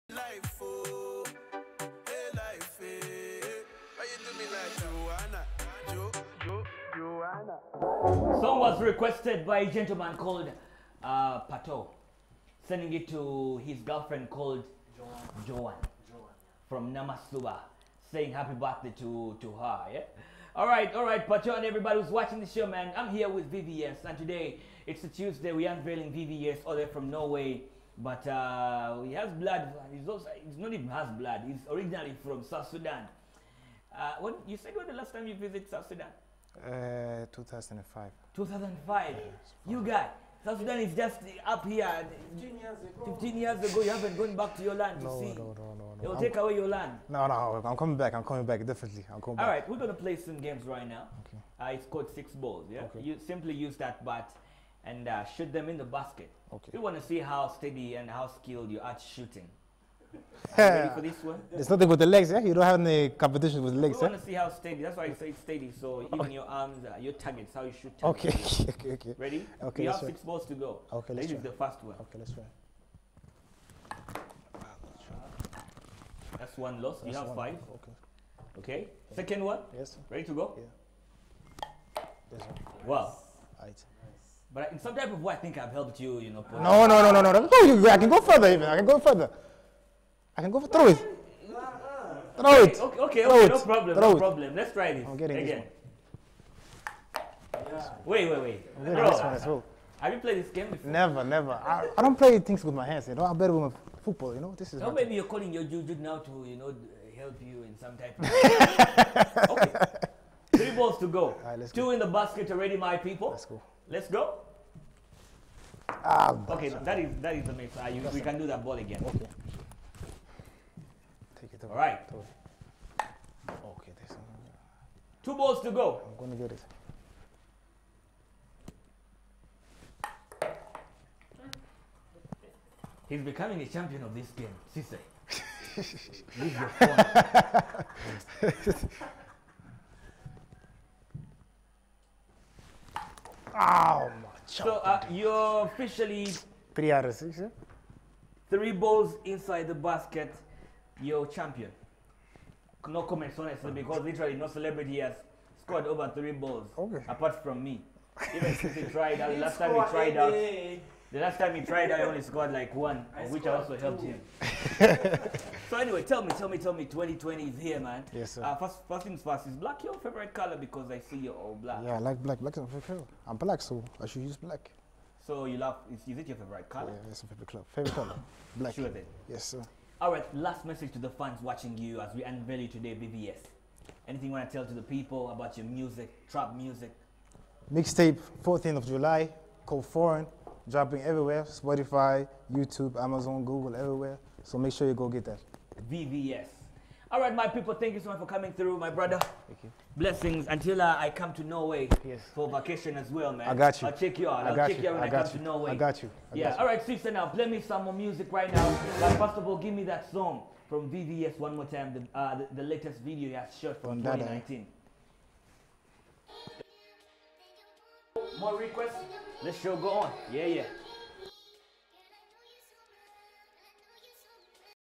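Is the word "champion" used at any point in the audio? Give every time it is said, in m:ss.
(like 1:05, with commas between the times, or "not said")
2:13, 2:31.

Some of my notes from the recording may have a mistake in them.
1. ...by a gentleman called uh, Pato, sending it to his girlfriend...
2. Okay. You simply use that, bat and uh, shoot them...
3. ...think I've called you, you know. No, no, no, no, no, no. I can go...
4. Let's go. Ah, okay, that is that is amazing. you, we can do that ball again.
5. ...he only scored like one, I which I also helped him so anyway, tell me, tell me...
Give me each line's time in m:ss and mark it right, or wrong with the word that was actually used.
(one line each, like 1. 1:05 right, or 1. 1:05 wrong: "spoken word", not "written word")
1. 0:09 right
2. 0:52 right
3. 1:25 wrong: "helped", not "called"
4. 1:53 right
5. 2:41 right.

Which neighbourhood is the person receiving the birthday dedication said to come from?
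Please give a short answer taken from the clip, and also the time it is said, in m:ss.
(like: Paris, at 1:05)
Namasuba, at 0:16.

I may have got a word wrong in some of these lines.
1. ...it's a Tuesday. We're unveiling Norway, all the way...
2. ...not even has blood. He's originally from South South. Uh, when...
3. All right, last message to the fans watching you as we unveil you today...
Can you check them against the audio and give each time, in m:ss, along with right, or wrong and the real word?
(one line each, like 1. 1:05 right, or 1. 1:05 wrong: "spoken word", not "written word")
1. 0:24 wrong: "VVS", not "Norway"
2. 0:30 wrong: "Sudan", not "South"
3. 2:59 right.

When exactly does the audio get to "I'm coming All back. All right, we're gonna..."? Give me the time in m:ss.
0:49.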